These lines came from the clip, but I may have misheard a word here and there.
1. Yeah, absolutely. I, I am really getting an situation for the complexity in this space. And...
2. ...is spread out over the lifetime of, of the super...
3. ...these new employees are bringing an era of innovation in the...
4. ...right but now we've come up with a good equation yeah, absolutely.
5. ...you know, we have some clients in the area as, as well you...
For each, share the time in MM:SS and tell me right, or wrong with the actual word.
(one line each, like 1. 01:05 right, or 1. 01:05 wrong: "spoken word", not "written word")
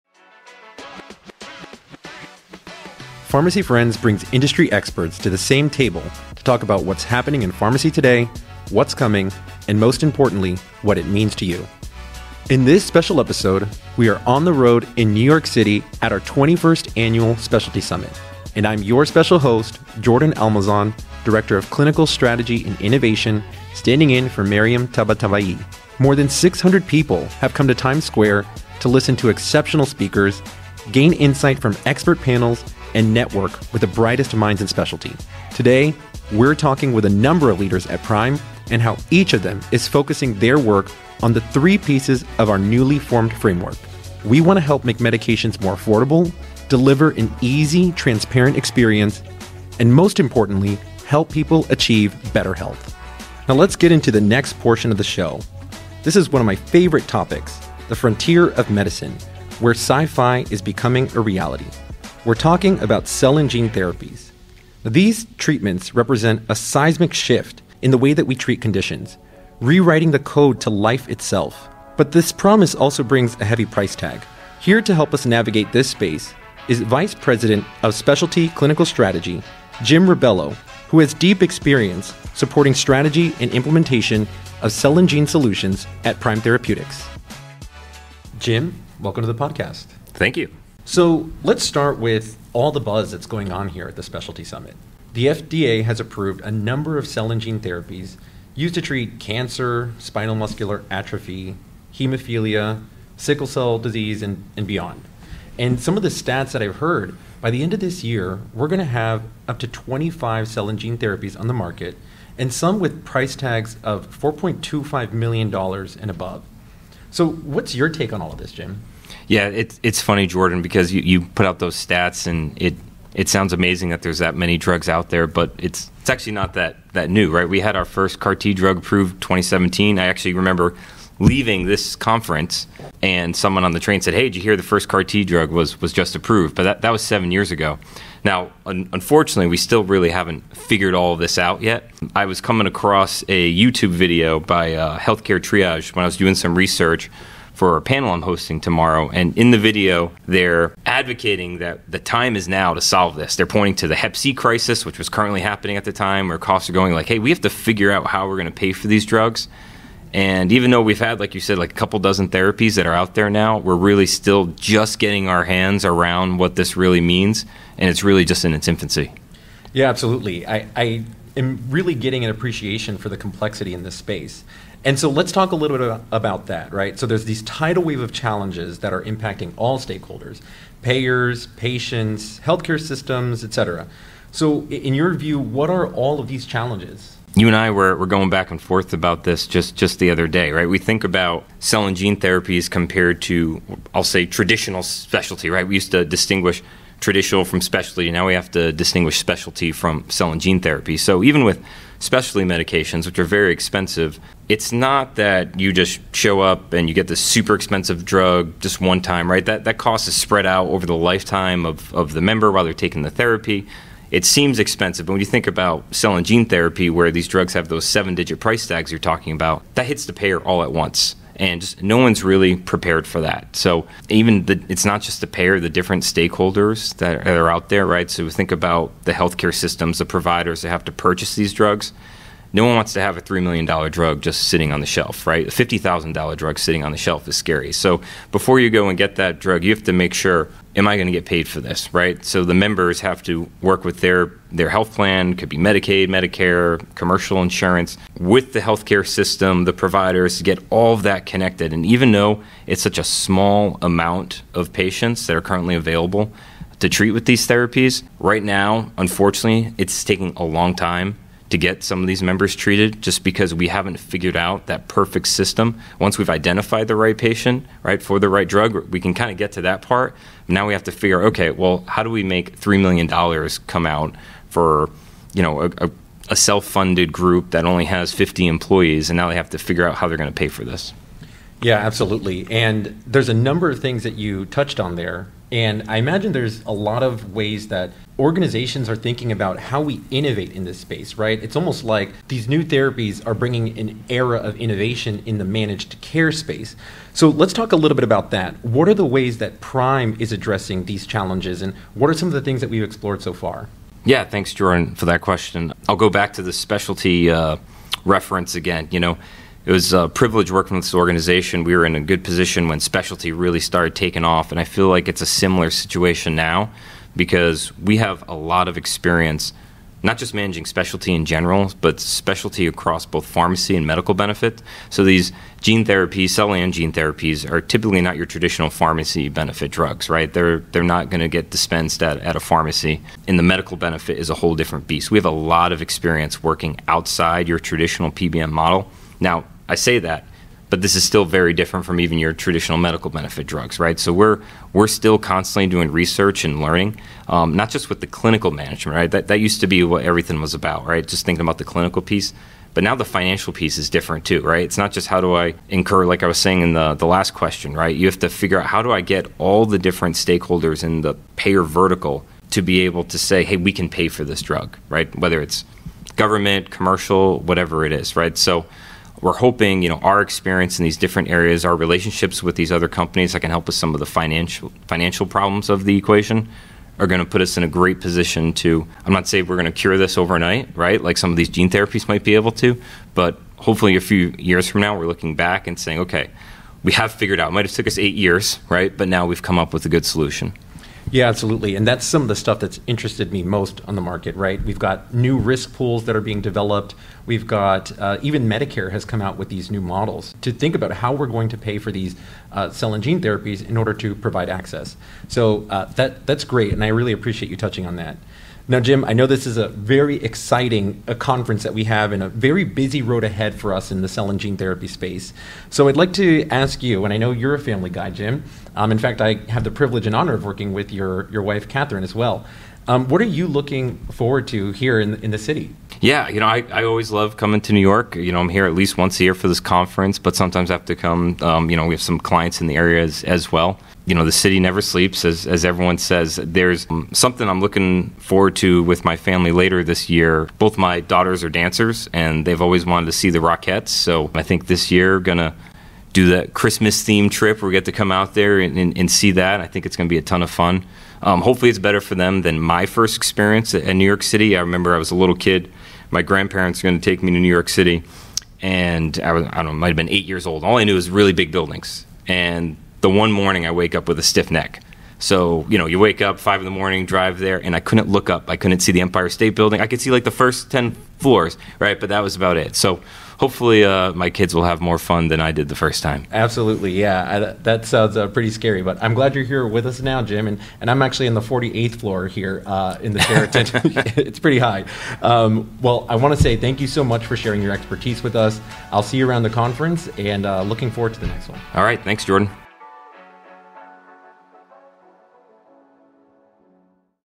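1. 02:49 wrong: "appreciation", not "situation"
2. 03:30 wrong: "member", not "super"
3. 04:52 wrong: "therapies", not "employees"
4. 06:28 wrong: "solution", not "equation"
5. 07:11 right.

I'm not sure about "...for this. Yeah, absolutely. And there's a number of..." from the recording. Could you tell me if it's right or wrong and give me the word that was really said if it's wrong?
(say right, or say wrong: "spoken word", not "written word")
right.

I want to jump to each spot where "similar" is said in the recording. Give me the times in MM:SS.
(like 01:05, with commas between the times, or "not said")
05:15.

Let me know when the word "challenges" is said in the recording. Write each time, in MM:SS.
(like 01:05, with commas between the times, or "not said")
02:58, 03:06, 05:01.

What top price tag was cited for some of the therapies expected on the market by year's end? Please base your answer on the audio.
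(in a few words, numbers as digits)
$4.25 million.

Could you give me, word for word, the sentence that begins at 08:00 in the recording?
And, and I'm actually in the 48th floor here uh, in the Sheraton.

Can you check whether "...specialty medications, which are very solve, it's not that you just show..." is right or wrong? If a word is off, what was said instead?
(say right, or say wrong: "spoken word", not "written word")
wrong: "expensive", not "solve".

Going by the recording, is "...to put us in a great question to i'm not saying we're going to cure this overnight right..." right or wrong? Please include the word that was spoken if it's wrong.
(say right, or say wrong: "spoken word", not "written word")
wrong: "position", not "question".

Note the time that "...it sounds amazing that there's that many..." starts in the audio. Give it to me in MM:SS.
02:03.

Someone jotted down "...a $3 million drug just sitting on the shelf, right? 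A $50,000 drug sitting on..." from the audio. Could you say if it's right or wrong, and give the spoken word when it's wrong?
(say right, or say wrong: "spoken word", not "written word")
right.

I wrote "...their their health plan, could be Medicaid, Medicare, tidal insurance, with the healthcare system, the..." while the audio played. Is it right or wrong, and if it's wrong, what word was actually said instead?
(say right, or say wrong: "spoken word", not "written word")
wrong: "commercial", not "tidal".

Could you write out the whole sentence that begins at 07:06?
Yeah, you know, I, I always love coming to New York.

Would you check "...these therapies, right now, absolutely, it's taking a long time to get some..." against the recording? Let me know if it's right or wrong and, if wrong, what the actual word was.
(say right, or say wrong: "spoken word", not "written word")
wrong: "unfortunately", not "absolutely".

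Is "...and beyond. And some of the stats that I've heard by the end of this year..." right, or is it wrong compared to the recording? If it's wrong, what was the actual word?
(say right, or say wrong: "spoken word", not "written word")
right.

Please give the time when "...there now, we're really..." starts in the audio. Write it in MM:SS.
02:43.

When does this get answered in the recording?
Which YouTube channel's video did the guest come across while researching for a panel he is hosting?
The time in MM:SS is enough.
02:24.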